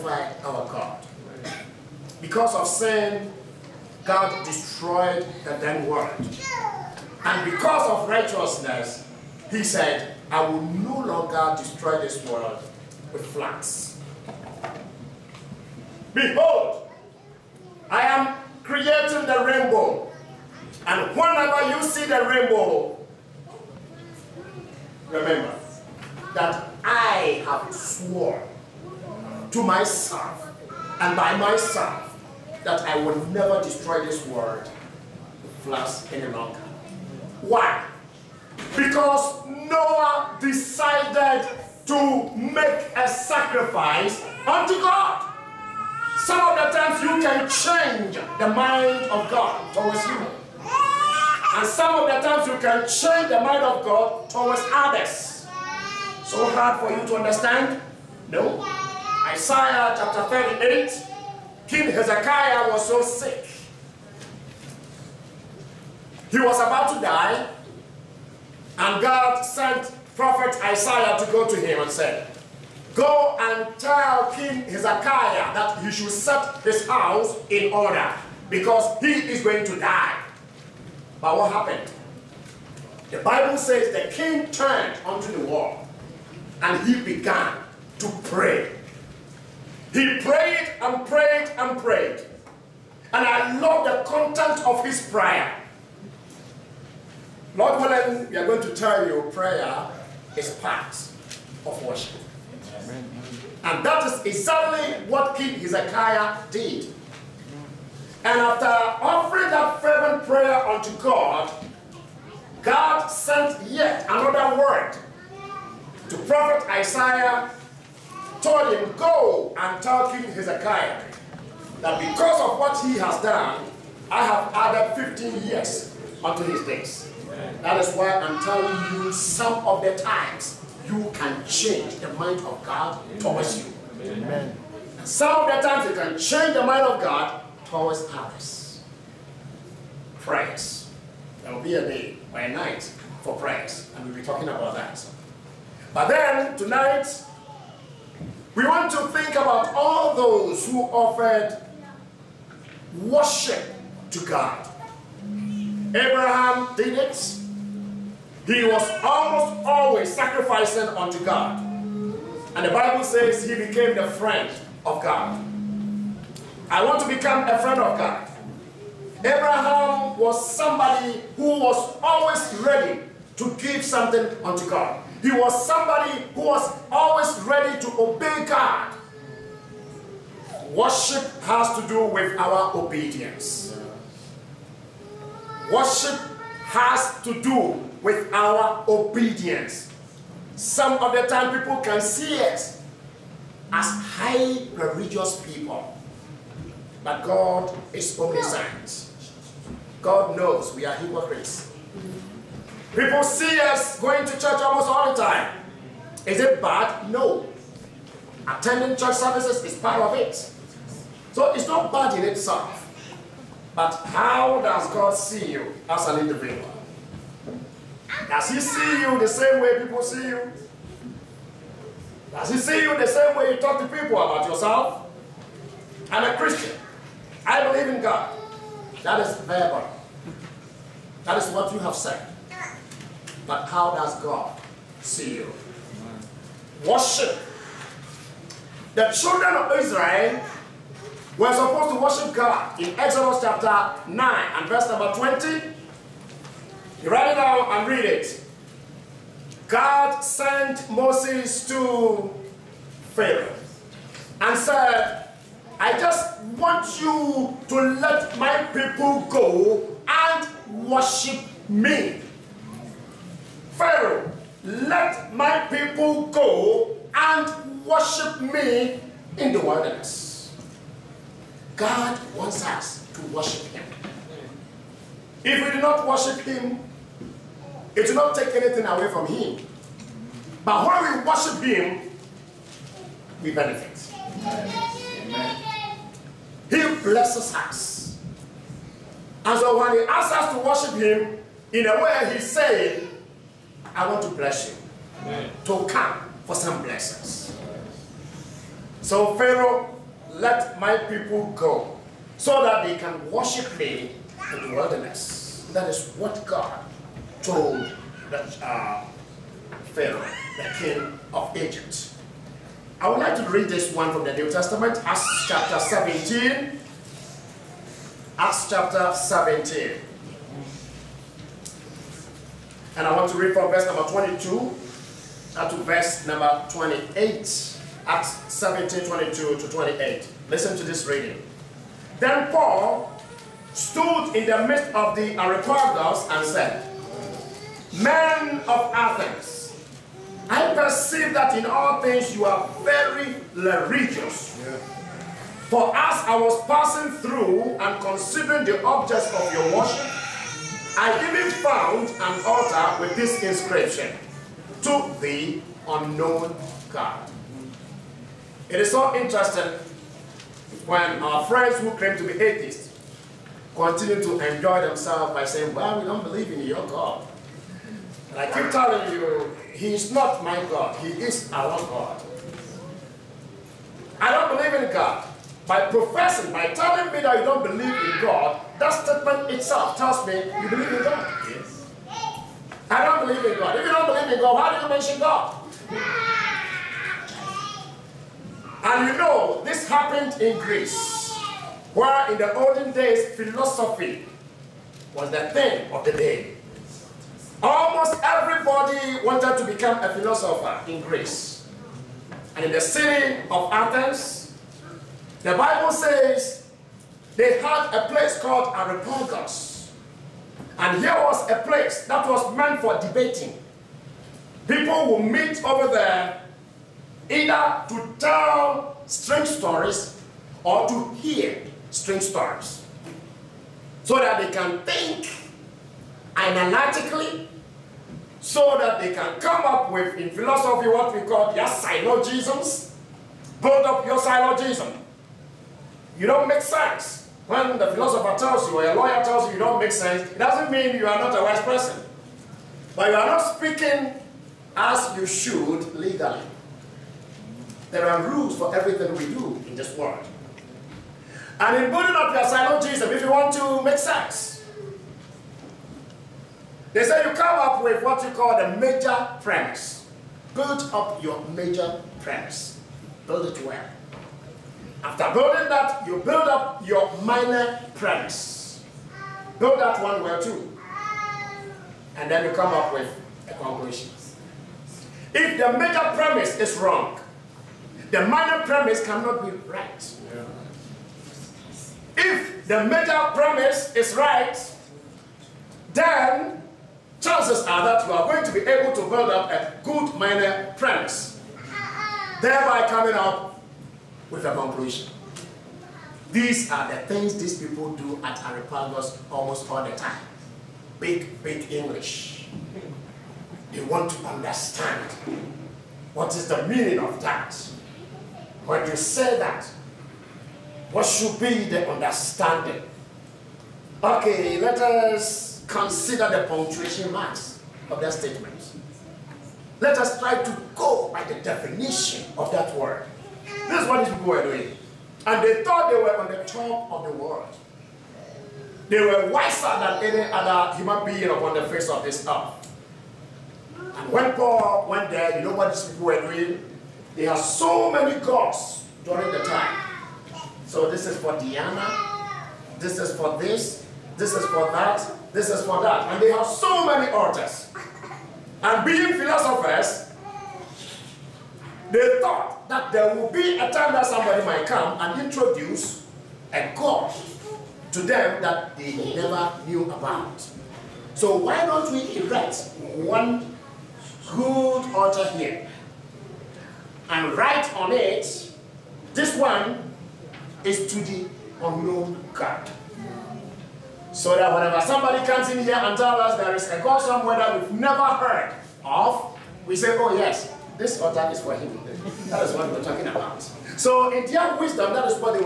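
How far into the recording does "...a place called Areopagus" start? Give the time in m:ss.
6:47.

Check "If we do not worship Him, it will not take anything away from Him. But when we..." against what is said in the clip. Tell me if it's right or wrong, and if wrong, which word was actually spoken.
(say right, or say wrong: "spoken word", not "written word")
right.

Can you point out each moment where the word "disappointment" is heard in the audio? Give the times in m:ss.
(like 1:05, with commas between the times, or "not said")
not said.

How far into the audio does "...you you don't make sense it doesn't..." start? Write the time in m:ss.
7:19.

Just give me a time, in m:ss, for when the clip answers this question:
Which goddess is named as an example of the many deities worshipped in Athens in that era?
9:01.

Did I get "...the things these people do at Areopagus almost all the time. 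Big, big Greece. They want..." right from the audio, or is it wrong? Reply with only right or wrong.
wrong.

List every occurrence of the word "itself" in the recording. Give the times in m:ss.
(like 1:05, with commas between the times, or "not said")
3:32, 6:19.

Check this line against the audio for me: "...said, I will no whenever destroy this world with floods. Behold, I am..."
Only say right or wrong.
wrong.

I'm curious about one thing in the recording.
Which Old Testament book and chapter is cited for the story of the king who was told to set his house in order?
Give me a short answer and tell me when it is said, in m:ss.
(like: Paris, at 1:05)
Isaiah 38, at 0:59.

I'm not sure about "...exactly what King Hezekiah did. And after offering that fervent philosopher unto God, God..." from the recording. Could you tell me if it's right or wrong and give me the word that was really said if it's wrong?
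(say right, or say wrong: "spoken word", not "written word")
wrong: "prayer", not "philosopher".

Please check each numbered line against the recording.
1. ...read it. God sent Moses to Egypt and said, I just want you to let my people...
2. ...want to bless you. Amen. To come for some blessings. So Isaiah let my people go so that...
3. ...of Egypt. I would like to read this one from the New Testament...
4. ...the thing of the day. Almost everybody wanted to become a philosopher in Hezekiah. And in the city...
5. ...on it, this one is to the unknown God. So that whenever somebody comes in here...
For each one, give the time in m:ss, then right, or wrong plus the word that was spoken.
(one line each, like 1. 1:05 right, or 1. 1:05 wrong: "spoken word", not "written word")
1. 4:07 wrong: "Pharaoh", not "Egypt"
2. 4:54 wrong: "Pharaoh", not "Isaiah"
3. 5:11 right
4. 6:35 wrong: "Greece", not "Hezekiah"
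5. 9:27 right.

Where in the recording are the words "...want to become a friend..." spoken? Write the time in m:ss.
2:46.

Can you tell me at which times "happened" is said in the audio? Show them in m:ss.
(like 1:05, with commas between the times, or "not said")
1:21, 6:29.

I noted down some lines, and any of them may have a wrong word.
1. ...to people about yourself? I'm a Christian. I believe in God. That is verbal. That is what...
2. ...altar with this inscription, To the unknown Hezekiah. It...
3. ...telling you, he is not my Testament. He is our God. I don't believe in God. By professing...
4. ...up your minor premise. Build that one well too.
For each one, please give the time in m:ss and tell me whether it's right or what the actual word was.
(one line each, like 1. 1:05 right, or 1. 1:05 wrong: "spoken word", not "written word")
1. 3:43 right
2. 5:52 wrong: "God", not "Hezekiah"
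3. 6:08 wrong: "God", not "Testament"
4. 7:46 right.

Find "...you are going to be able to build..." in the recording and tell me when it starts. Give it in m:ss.
8:08.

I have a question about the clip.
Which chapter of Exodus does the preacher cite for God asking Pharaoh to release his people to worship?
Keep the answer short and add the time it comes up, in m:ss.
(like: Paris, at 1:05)
9, at 4:02.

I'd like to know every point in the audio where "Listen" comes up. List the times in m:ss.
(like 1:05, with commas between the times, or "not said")
5:30.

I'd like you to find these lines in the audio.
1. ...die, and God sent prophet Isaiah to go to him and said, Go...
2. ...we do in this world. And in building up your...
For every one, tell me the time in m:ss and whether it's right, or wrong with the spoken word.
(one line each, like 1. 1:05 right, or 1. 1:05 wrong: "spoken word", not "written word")
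1. 1:06 right
2. 7:29 right.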